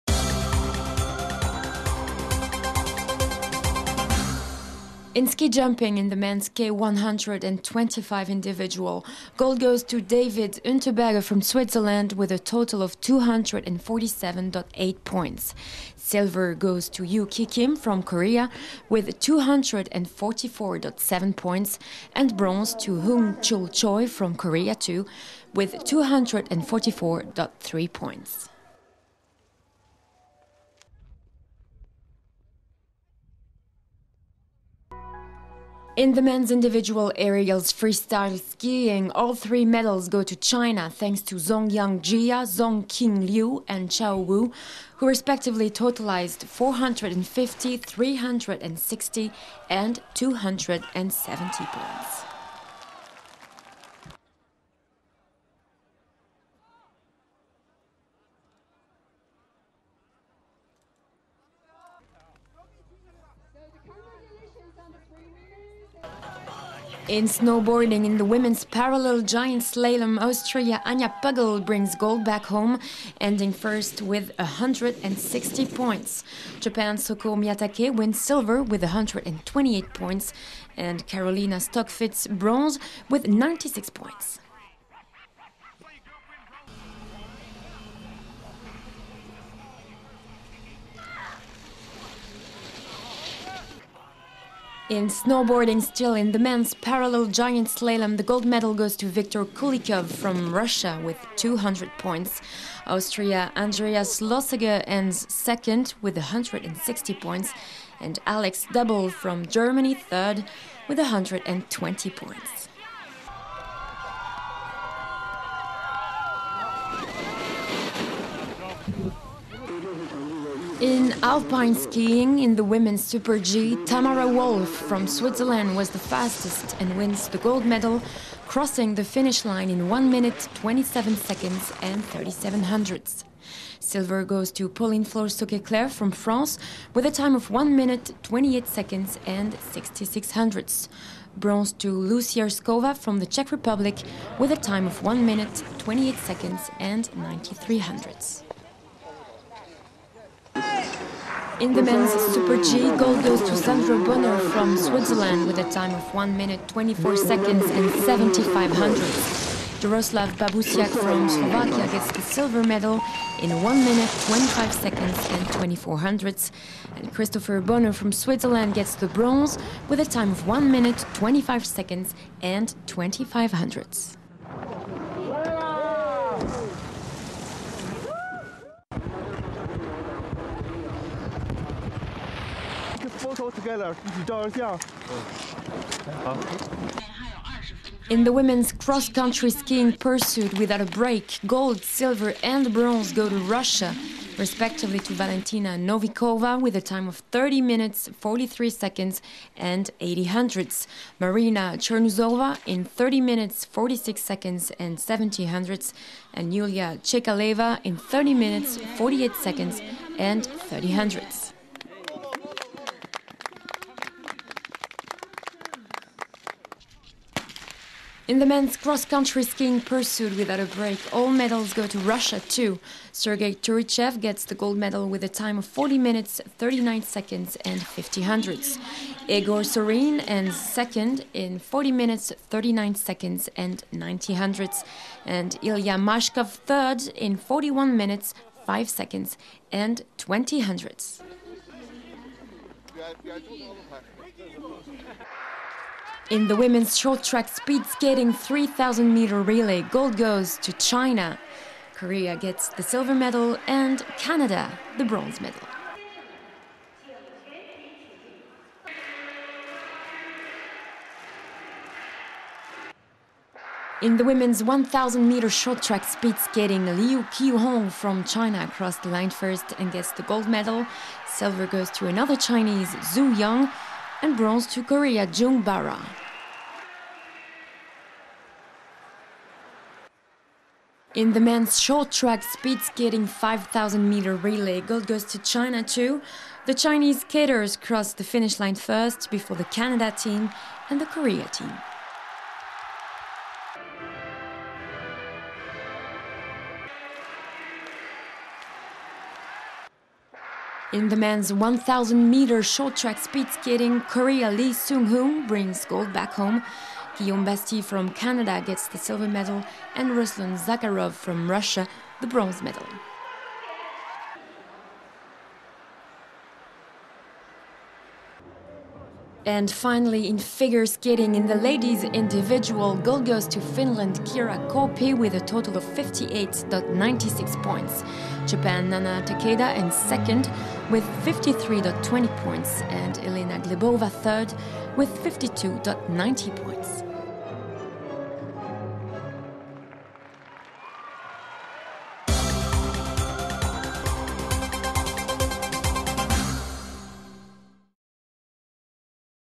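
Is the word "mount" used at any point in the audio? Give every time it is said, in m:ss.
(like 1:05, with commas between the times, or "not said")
not said.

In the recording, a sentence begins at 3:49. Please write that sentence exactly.
Igor Sorin ends second in 40 minutes, 39 seconds and 90 hundredths.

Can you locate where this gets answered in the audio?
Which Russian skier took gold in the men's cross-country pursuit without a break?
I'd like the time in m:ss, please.
3:43.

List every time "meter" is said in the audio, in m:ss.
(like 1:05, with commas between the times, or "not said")
4:09, 4:25, 4:44, 5:02.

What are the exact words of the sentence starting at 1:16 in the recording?
Japan's Soko Miyatake wins silver with 128 points, and Carolina Stockfitz bronze with 96 points.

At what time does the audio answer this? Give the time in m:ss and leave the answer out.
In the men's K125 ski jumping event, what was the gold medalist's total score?
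0:13.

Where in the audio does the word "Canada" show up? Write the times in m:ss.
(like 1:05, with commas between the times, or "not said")
4:14, 4:49, 5:08.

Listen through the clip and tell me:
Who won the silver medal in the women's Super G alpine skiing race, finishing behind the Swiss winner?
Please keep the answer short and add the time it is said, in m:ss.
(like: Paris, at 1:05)
Pauline Flores-Sauquet-Claire, at 2:14.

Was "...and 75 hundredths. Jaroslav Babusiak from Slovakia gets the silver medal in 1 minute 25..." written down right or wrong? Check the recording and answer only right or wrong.
right.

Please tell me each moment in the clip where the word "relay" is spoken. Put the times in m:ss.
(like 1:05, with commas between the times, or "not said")
4:09, 4:44.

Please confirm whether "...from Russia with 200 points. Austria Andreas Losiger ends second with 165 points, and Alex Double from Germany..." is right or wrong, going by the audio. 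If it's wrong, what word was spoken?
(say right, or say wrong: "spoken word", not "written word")
wrong: "160", not "165".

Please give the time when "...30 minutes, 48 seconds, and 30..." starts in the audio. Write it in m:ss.
3:27.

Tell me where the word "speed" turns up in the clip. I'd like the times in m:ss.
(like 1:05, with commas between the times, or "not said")
4:07, 4:26, 4:42, 5:03.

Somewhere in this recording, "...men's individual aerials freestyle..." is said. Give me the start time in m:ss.
0:36.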